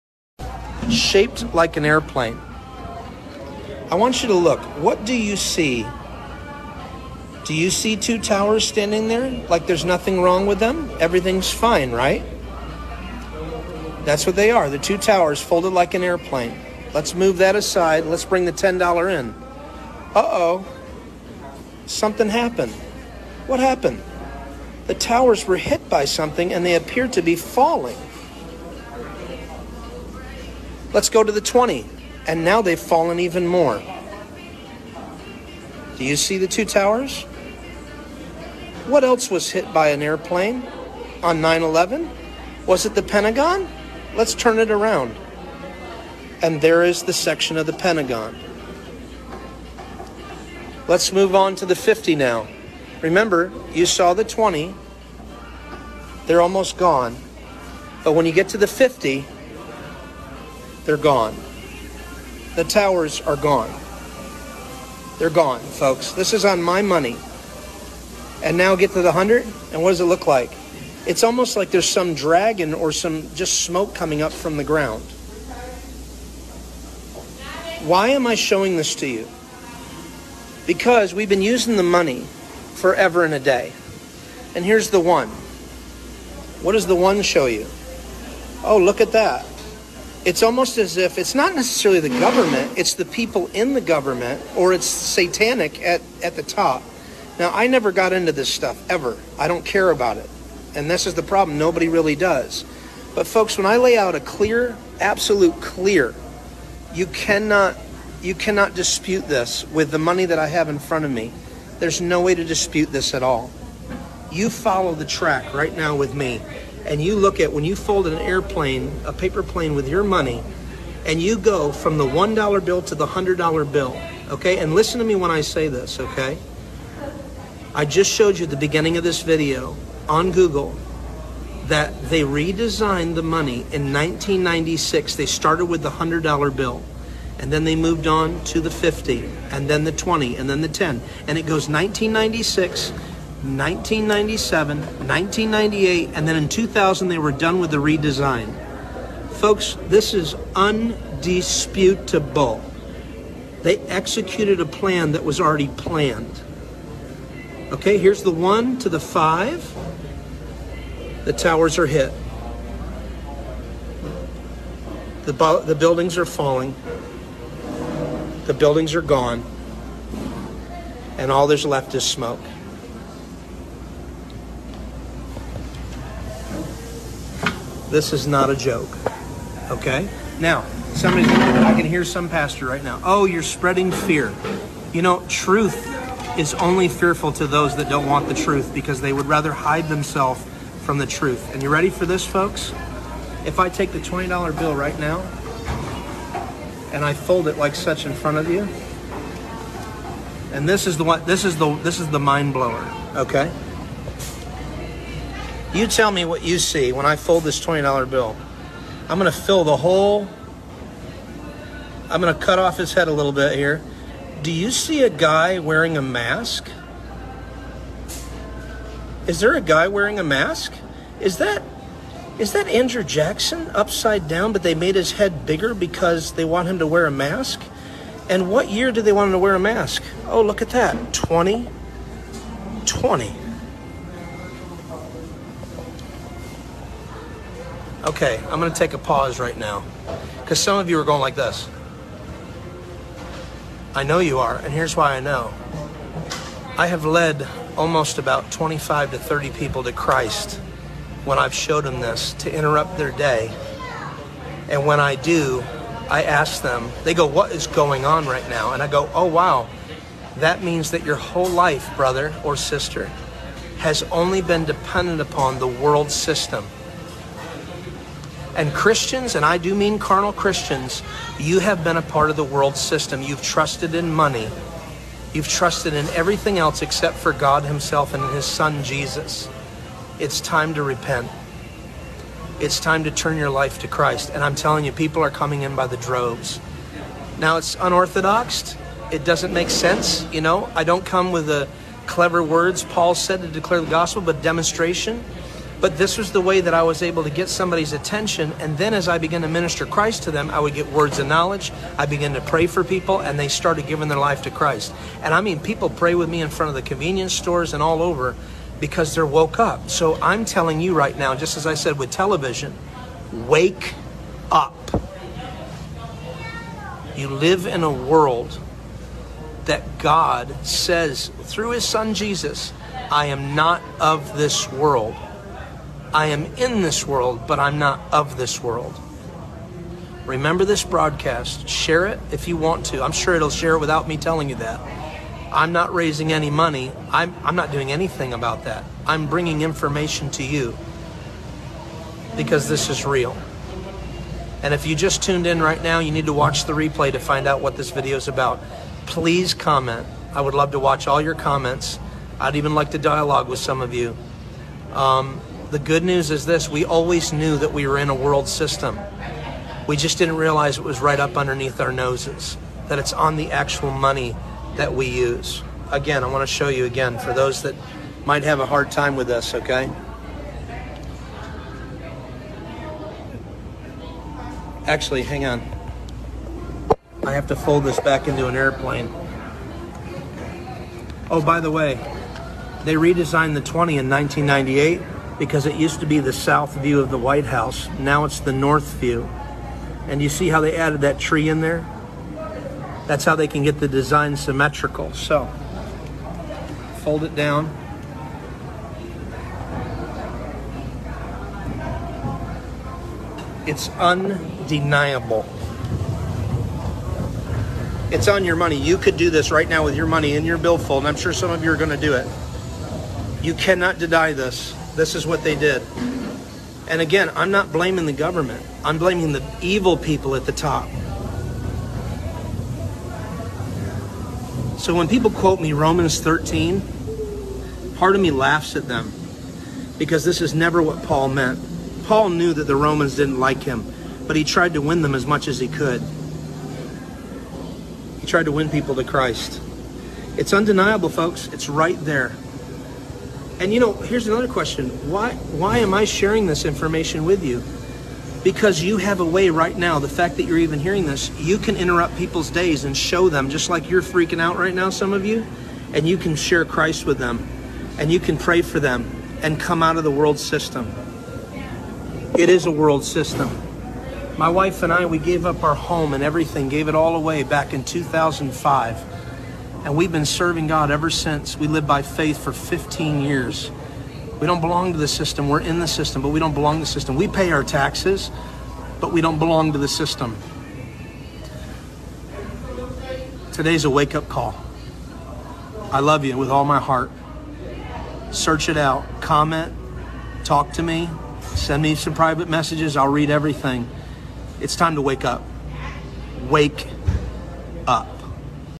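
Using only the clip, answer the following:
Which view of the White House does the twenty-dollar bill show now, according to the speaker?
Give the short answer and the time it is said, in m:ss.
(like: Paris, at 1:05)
North view, at 6:28.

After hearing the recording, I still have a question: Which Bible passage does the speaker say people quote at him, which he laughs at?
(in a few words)
Romans 13.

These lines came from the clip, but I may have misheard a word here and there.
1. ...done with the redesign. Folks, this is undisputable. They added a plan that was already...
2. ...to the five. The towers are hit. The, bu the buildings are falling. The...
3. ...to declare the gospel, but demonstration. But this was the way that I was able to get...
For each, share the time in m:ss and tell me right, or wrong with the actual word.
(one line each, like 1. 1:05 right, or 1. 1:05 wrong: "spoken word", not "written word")
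1. 2:27 wrong: "executed", not "added"
2. 2:38 right
3. 4:53 right.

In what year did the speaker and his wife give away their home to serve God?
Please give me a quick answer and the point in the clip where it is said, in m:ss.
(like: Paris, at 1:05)
2005, at 7:47.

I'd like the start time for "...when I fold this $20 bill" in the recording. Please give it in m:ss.
3:26.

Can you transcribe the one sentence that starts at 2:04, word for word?
And listen to me when I say this, okay?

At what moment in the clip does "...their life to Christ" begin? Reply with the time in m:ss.
5:04.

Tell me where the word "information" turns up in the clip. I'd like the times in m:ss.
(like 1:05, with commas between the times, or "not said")
5:39, 7:26.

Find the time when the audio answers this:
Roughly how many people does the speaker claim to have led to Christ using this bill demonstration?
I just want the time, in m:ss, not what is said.
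4:08.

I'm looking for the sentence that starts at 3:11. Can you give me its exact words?
And you ready for this, folks?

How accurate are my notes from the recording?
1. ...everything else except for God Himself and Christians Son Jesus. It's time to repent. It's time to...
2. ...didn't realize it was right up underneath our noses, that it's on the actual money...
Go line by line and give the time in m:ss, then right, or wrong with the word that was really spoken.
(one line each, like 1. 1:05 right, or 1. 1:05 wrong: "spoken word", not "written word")
1. 4:36 wrong: "His", not "Christians"
2. 6:00 right.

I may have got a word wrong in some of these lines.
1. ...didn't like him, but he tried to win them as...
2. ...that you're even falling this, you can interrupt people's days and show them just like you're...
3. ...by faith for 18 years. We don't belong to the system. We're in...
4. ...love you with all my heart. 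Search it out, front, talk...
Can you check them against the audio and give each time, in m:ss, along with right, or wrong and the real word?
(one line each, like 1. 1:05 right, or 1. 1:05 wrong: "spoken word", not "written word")
1. 7:13 right
2. 7:30 wrong: "hearing", not "falling"
3. 7:51 wrong: "15", not "18"
4. 8:05 wrong: "comment", not "front".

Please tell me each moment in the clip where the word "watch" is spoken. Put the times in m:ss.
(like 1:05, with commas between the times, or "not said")
5:46, 5:50.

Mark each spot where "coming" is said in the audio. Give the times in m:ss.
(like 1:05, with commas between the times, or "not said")
1:13, 4:45.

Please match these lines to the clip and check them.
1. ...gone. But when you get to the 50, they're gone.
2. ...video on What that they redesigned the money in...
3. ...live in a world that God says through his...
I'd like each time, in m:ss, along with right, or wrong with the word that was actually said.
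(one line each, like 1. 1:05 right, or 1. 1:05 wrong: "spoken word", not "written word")
1. 0:56 right
2. 2:09 wrong: "Google", not "What"
3. 5:17 right.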